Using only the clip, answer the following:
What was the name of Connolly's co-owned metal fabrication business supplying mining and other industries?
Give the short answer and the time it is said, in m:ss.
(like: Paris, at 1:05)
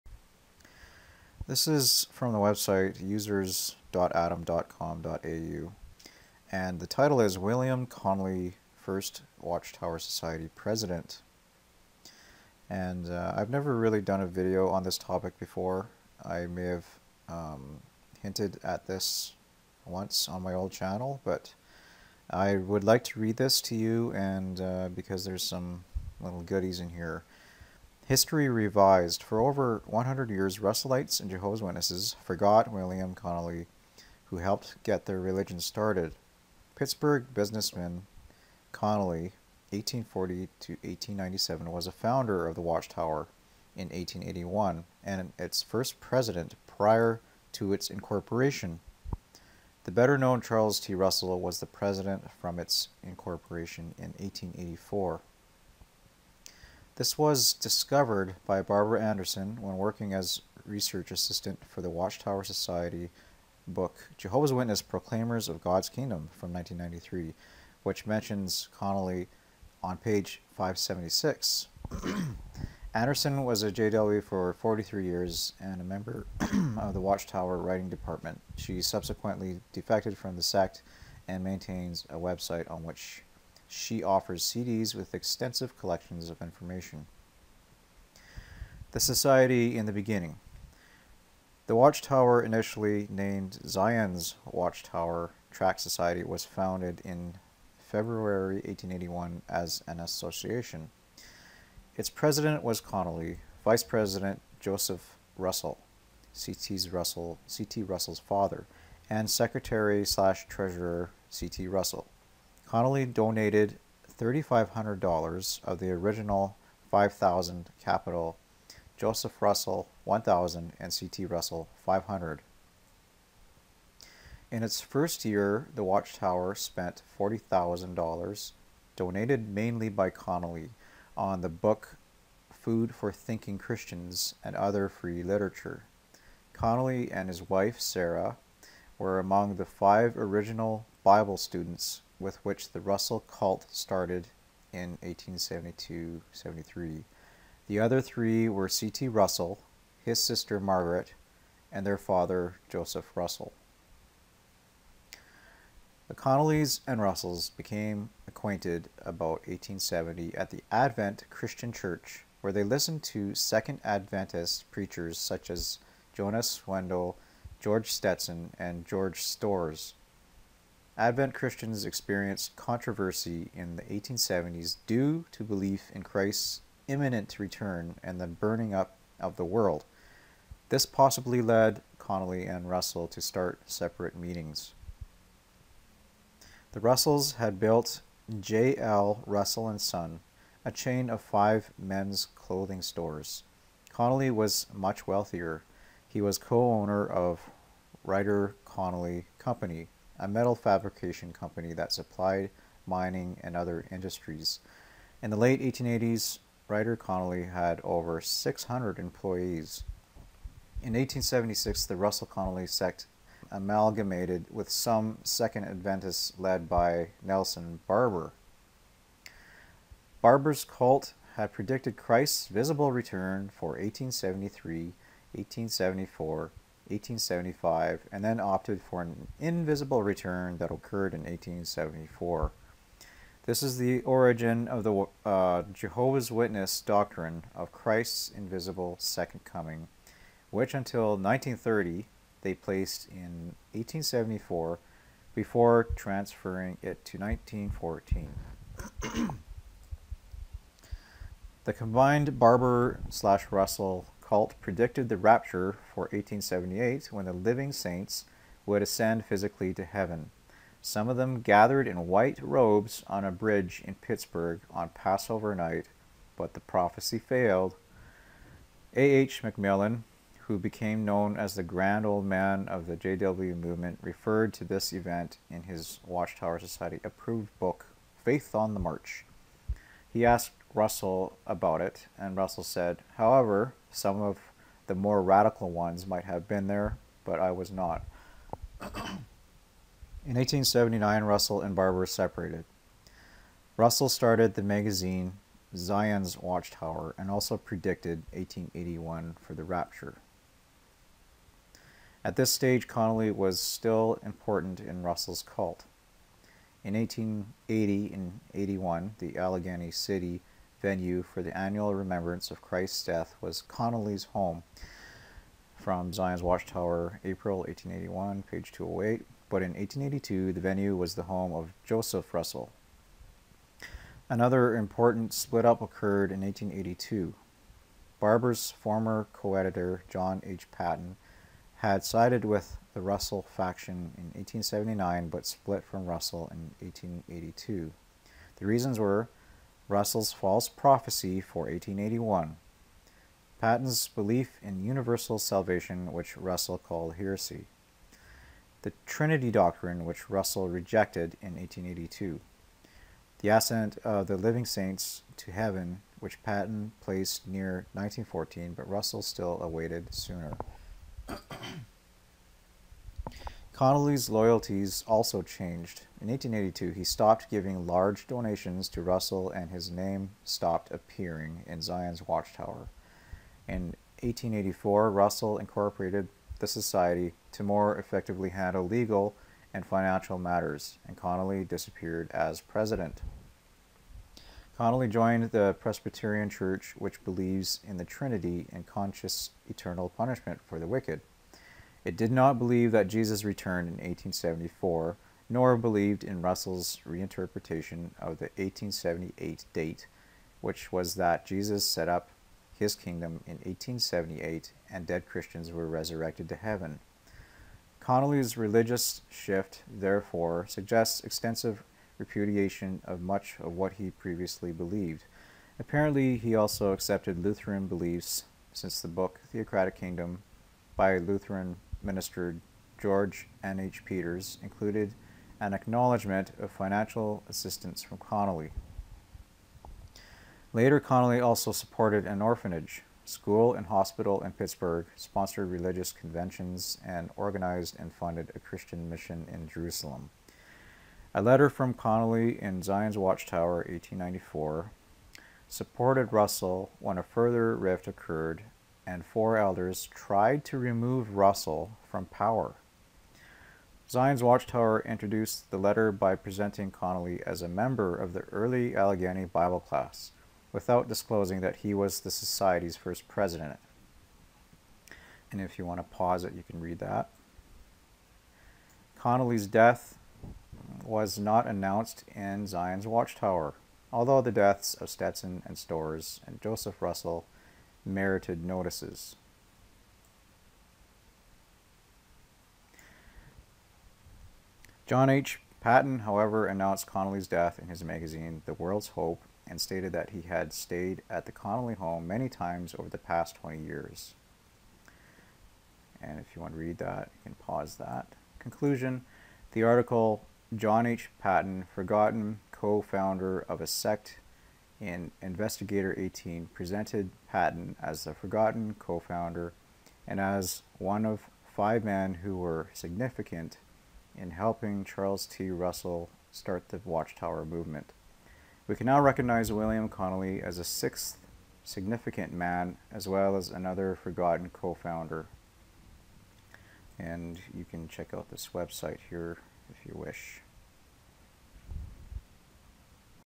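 Rider Connolly Company, at 3:18.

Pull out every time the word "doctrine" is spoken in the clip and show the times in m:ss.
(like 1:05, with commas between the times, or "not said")
3:56, 5:49.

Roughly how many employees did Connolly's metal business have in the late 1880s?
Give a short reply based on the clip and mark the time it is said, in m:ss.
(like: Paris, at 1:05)
600, at 3:28.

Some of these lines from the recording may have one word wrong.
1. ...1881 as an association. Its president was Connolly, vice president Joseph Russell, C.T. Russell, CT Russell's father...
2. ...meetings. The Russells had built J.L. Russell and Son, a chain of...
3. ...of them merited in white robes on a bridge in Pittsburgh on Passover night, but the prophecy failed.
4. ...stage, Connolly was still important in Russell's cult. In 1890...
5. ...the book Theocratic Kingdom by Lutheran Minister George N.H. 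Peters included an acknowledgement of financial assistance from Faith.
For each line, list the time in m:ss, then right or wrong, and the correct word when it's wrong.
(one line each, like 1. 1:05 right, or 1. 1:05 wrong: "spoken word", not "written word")
1. 1:38 right
2. 3:04 right
3. 4:21 wrong: "gathered", not "merited"
4. 5:02 wrong: "1880", not "1890"
5. 6:59 wrong: "Connolly", not "Faith".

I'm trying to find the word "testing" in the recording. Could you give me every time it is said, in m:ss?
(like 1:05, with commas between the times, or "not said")
not said.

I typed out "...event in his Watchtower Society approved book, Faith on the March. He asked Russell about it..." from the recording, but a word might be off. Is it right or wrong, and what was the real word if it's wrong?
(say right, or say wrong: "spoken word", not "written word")
right.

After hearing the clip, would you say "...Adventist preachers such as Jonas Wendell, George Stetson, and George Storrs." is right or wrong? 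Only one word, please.
right.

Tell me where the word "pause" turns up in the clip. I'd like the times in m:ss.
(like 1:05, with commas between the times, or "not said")
7:46, 8:17.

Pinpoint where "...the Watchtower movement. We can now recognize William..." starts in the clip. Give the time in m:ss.
8:36.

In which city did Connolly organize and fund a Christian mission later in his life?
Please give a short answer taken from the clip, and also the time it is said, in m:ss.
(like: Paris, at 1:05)
Jerusalem, at 7:19.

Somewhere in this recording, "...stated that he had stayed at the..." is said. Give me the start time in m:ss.
8:09.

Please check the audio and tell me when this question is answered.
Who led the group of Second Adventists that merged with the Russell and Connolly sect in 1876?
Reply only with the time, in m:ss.
3:37.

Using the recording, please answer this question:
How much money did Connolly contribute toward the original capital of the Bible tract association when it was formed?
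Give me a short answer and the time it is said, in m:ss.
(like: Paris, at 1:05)
$3,500, at 1:54.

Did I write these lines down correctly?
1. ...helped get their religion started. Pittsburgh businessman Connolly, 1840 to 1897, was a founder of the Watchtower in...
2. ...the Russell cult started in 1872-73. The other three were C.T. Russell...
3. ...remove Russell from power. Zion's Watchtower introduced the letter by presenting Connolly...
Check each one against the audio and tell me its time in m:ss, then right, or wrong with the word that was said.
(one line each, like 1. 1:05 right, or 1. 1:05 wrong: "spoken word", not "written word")
1. 0:34 right
2. 2:22 right
3. 7:30 right.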